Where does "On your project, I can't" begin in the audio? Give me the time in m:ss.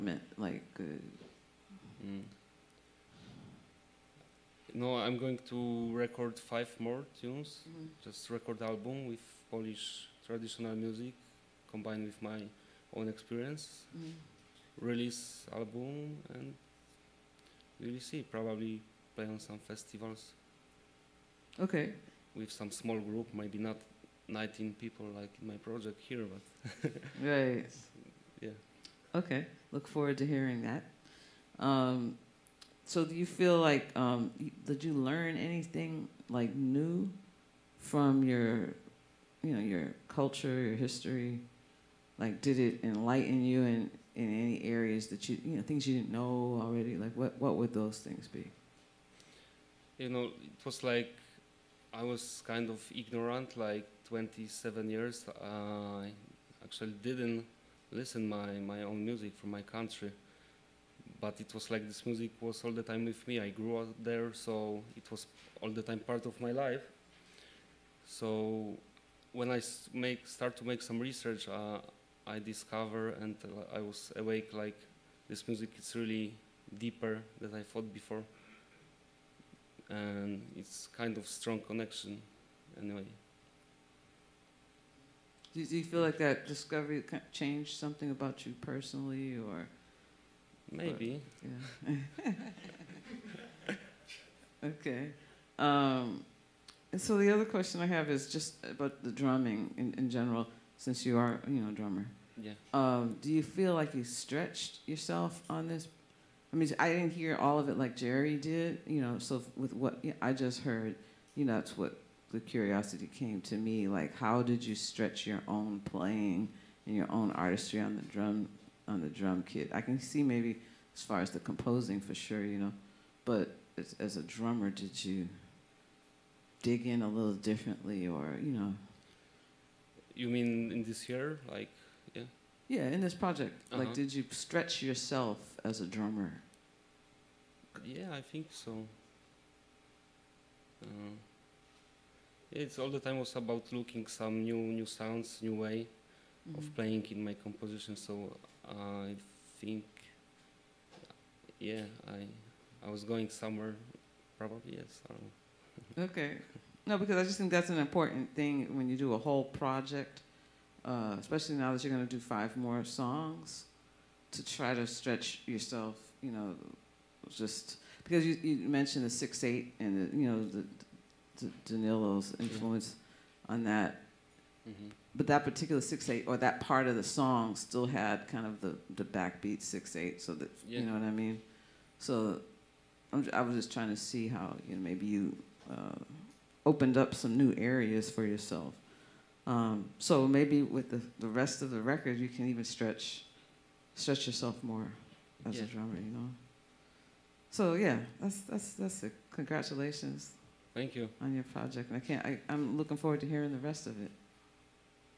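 3:21.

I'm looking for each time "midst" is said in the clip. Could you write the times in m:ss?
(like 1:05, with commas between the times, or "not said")
not said.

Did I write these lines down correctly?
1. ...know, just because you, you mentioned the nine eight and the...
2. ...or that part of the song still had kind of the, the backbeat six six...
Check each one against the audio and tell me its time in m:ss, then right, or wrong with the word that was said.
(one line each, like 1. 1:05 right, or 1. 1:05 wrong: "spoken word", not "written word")
1. 2:46 wrong: "six", not "nine"
2. 2:56 wrong: "eight", not "six".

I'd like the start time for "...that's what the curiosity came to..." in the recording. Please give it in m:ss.
1:51.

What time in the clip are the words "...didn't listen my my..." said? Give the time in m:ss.
0:57.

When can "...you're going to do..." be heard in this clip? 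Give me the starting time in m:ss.
2:41.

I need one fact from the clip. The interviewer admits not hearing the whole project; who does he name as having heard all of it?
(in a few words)
Jerry.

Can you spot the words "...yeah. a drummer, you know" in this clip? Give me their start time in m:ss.
3:15.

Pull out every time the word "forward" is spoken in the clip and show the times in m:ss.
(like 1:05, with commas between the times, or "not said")
0:29, 3:22.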